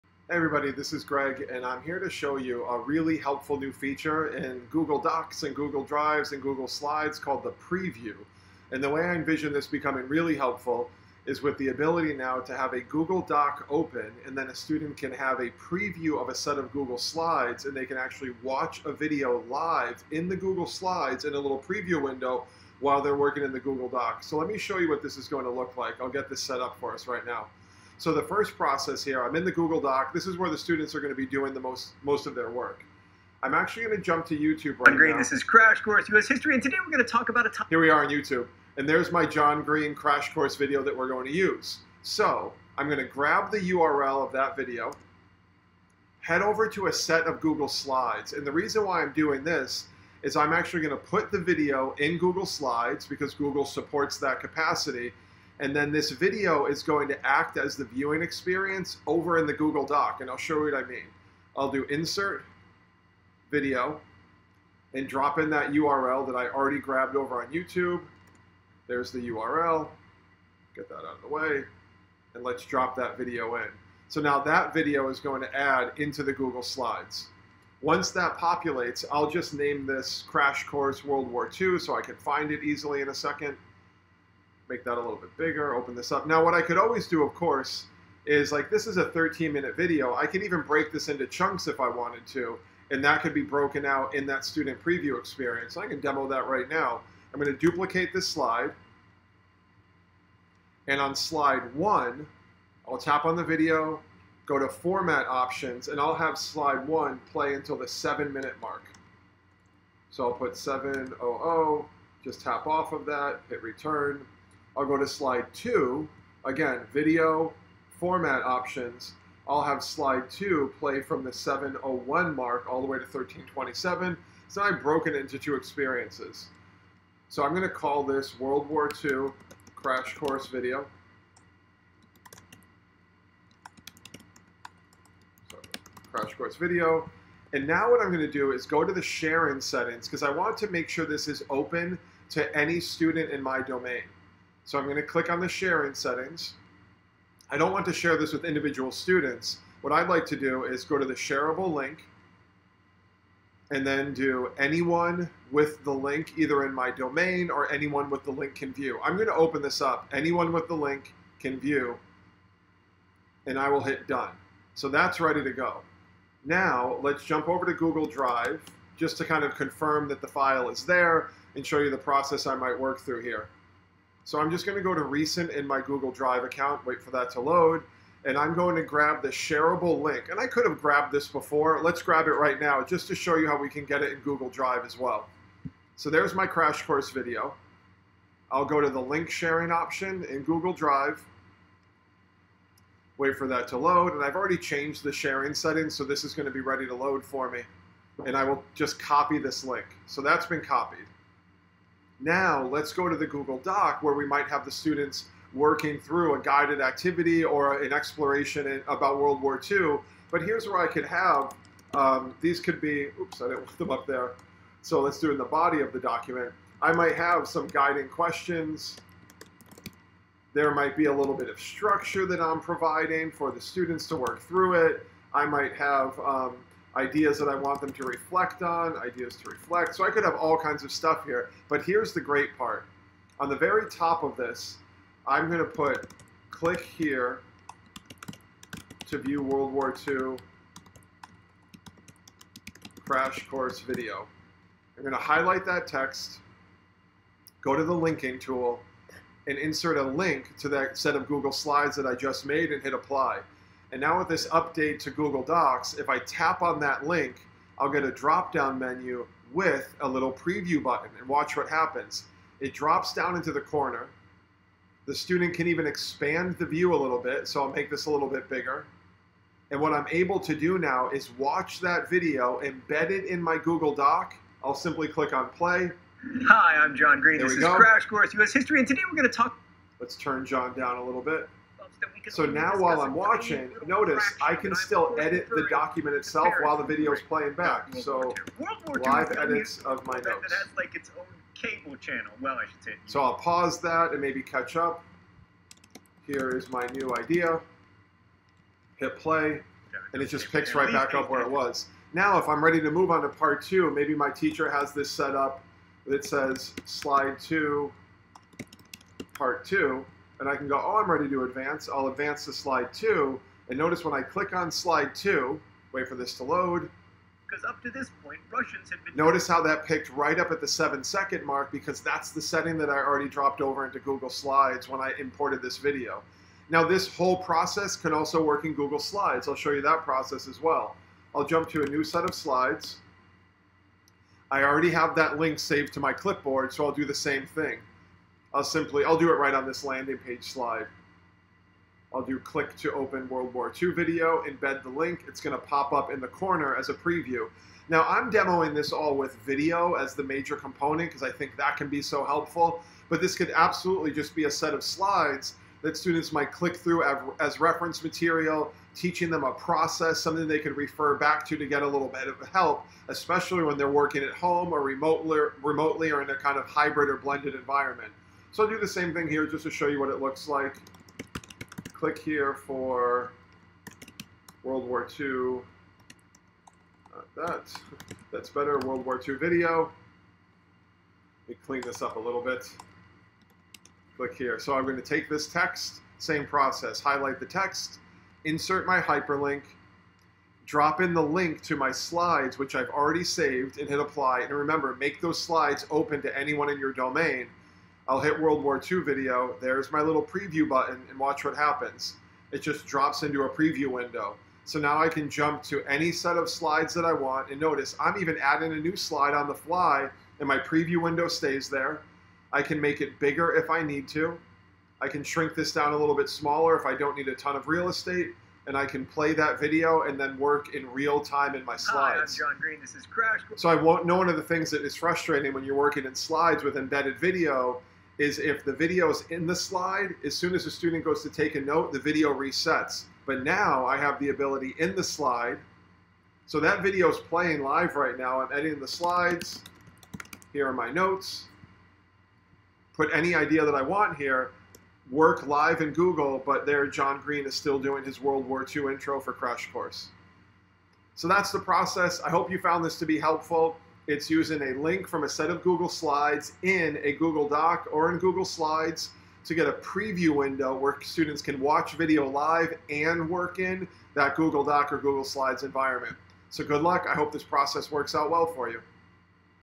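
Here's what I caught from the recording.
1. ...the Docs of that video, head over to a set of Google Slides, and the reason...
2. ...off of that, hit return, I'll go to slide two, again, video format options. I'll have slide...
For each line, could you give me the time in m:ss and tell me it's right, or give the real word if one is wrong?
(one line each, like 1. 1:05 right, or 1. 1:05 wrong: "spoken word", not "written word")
1. 0:43 wrong: "URL", not "Docs"
2. 1:52 right.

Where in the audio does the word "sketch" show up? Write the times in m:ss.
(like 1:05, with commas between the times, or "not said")
not said.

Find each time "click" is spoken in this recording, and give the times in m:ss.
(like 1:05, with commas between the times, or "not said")
2:25, 3:56, 4:35, 5:14, 5:42, 5:56, 6:11, 6:24.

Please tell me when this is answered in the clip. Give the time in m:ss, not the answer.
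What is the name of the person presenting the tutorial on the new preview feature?
0:01.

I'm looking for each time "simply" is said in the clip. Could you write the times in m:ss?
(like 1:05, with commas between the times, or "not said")
4:34, 5:38.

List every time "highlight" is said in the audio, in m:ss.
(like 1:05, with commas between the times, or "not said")
4:05, 6:26.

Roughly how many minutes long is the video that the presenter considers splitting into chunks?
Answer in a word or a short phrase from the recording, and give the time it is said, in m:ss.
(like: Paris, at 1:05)
13, at 1:29.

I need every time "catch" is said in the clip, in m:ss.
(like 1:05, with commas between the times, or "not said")
4:54.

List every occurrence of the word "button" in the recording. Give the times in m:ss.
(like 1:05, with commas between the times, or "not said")
4:20, 6:40.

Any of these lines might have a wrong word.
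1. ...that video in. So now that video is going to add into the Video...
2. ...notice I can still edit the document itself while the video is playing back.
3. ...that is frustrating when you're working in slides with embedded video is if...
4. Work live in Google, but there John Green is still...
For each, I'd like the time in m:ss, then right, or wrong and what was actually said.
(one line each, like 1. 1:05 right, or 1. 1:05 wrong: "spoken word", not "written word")
1. 1:12 wrong: "Google", not "Video"
2. 4:43 right
3. 7:04 right
4. 7:25 right.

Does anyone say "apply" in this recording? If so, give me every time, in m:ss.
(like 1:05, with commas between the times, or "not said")
4:12, 6:34.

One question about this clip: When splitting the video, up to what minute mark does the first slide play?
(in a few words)
7.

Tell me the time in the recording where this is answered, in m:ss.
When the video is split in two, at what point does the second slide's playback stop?
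2:03.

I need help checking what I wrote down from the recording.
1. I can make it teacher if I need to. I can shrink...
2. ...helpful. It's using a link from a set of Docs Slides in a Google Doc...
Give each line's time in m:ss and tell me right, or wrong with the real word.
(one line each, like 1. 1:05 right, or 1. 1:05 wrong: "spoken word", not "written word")
1. 6:52 wrong: "bigger", not "teacher"
2. 7:33 wrong: "Google", not "Docs".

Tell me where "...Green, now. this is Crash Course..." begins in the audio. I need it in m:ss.
0:34.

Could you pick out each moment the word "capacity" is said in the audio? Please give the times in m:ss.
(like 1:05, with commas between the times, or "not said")
0:54.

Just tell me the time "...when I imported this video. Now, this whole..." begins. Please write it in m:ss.
5:24.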